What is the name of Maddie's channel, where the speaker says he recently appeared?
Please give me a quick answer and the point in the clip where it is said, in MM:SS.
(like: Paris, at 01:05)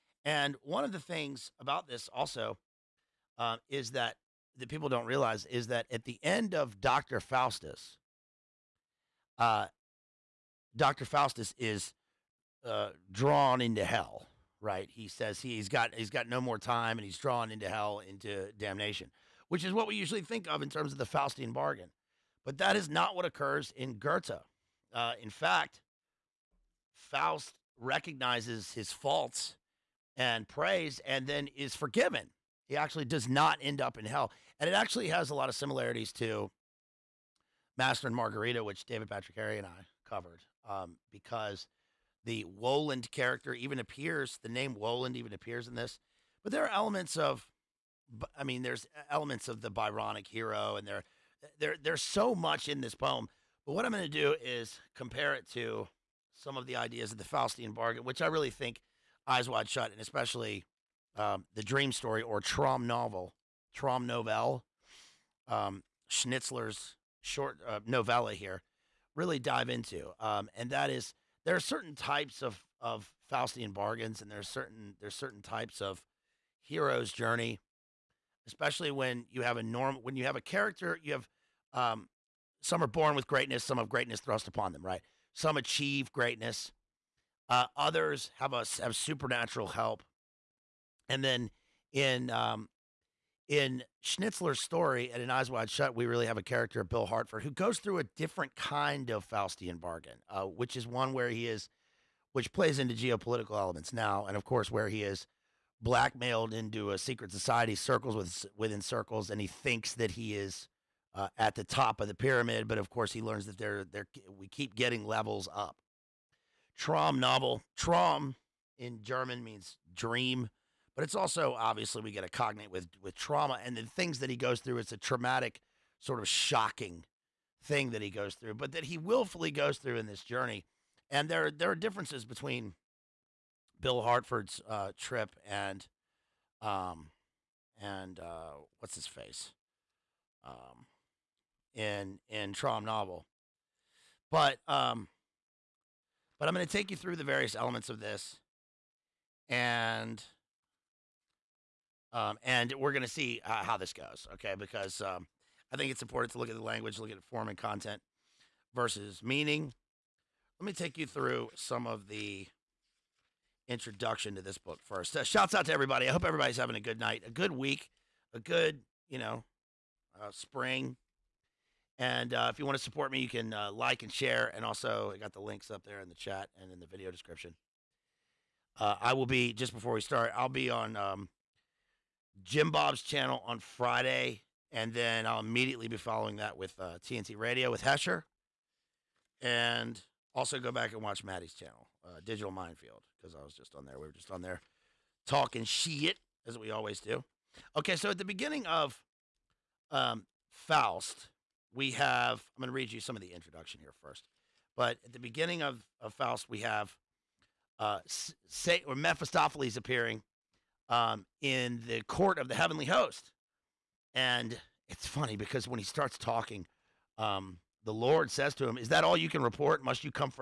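Digital Minefield, at 03:12.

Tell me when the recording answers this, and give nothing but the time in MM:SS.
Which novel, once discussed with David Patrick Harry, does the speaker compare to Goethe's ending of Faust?
00:37.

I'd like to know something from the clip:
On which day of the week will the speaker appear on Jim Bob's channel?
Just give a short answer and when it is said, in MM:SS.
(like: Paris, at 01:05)
Friday, at 03:03.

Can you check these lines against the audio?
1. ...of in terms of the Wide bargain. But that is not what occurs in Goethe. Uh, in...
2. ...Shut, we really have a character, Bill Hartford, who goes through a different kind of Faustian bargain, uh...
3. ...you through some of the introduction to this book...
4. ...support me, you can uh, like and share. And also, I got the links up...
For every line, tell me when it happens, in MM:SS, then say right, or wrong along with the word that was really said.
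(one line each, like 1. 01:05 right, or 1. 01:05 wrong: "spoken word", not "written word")
1. 00:20 wrong: "Faustian", not "Wide"
2. 01:35 right
3. 02:40 right
4. 02:52 right.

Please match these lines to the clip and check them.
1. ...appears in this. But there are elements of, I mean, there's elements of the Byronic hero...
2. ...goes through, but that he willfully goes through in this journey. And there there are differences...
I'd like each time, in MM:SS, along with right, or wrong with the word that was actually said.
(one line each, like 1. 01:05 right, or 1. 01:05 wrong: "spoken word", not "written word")
1. 00:45 right
2. 02:08 right.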